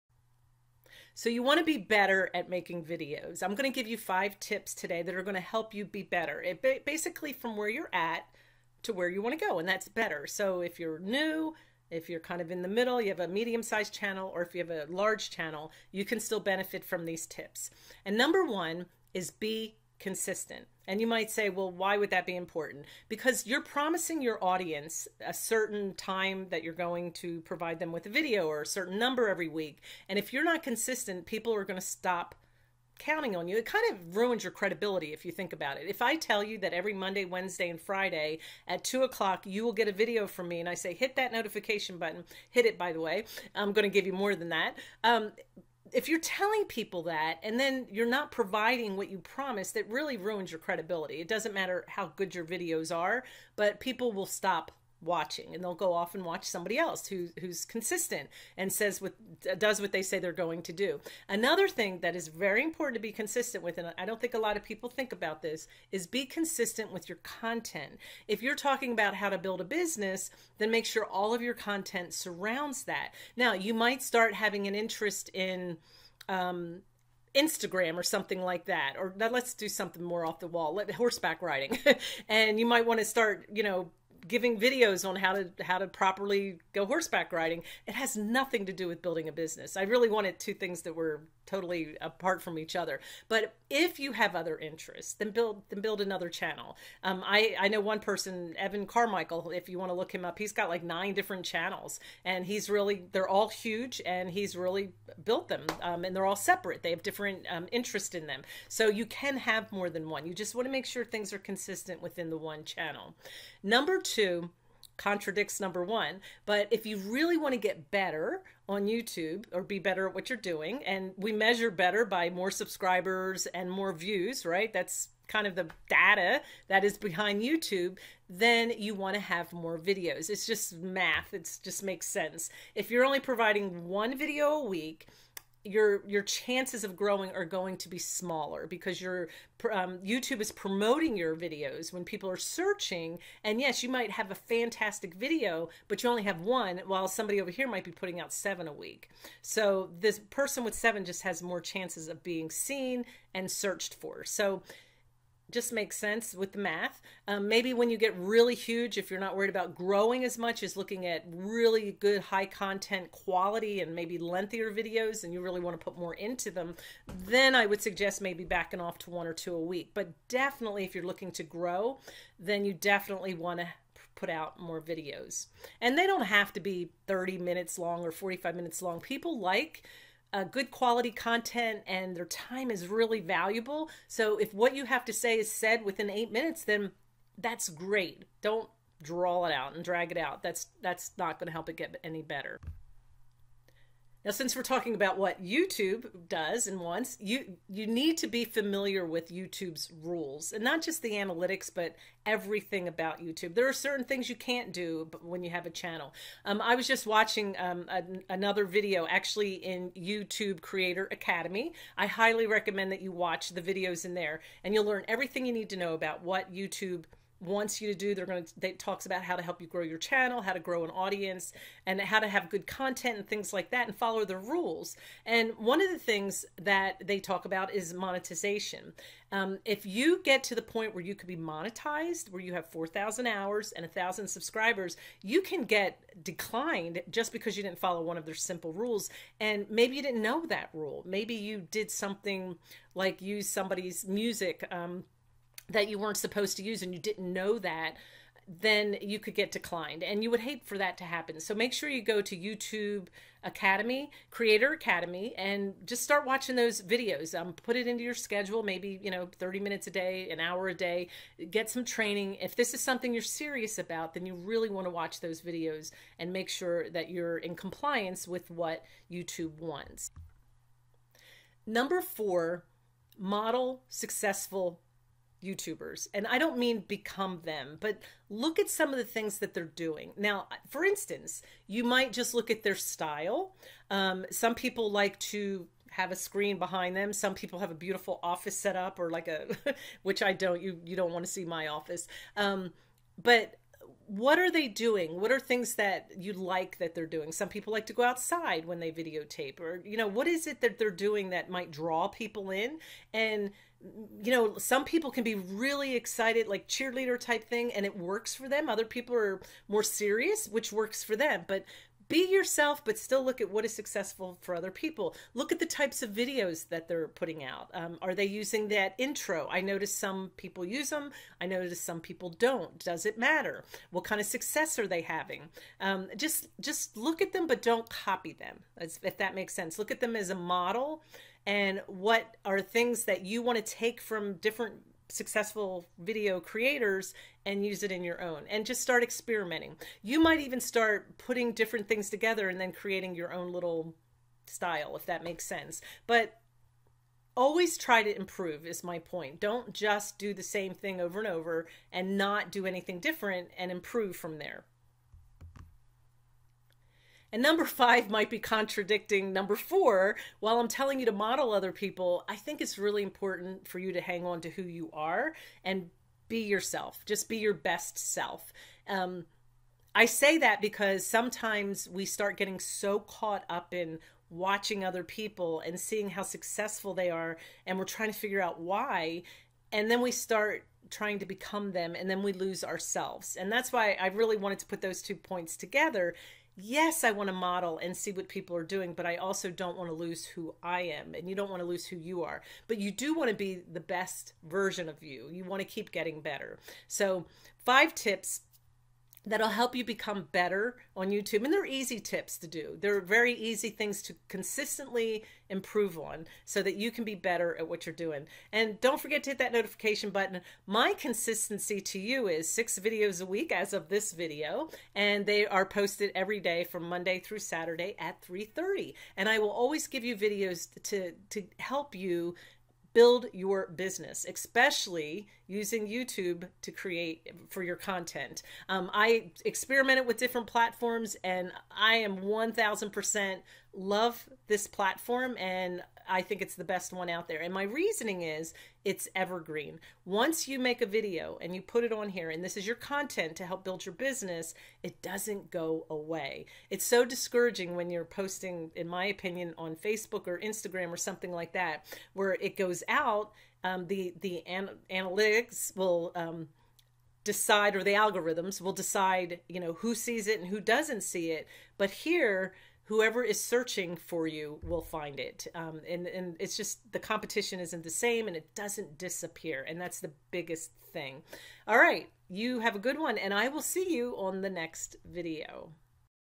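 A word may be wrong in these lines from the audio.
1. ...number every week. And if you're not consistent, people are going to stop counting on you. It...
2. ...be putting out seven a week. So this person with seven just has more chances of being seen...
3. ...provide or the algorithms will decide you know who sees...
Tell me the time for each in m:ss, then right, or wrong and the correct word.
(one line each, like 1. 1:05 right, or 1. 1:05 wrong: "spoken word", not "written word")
1. 0:28 right
2. 2:27 right
3. 7:37 wrong: "decide", not "provide".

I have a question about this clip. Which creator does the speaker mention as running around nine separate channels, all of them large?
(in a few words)
Evan Carmichael.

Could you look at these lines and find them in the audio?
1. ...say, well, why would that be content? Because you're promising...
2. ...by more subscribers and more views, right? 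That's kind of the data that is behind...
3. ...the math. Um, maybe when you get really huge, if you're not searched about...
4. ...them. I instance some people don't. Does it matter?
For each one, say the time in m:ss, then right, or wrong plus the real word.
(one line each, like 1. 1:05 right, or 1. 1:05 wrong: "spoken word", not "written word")
1. 0:21 wrong: "important", not "content"
2. 2:02 right
3. 2:36 wrong: "worried", not "searched"
4. 5:20 wrong: "notice", not "instance".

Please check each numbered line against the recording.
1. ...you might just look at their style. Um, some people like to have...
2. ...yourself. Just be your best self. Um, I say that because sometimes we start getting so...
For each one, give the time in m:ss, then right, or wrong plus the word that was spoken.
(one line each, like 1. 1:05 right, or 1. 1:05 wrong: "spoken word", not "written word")
1. 4:41 right
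2. 6:06 right.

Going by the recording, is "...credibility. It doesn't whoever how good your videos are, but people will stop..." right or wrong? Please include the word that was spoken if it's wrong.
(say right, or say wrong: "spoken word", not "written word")
wrong: "matter", not "whoever".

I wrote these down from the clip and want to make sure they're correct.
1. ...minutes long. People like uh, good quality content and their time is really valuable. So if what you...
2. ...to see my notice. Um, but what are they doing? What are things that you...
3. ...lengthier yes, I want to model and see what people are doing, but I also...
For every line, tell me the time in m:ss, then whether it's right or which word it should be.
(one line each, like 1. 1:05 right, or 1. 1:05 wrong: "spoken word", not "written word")
1. 2:58 right
2. 4:51 wrong: "office", not "notice"
3. 6:25 wrong: "together", not "lengthier".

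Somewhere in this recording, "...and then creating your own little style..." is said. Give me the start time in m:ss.
5:42.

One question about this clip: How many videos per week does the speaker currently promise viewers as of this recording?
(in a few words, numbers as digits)
6.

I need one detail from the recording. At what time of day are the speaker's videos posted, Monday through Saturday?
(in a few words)
3:30.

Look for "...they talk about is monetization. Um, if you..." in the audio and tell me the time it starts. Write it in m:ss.
3:47.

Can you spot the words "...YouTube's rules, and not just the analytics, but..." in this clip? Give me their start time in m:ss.
3:19.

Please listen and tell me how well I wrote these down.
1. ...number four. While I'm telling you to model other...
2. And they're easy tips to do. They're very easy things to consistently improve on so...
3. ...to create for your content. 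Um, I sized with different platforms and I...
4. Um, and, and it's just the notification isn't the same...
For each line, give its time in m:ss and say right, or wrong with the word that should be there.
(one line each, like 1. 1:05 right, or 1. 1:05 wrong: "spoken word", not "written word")
1. 5:59 right
2. 6:41 right
3. 7:06 wrong: "experimented", not "sized"
4. 7:45 wrong: "competition", not "notification".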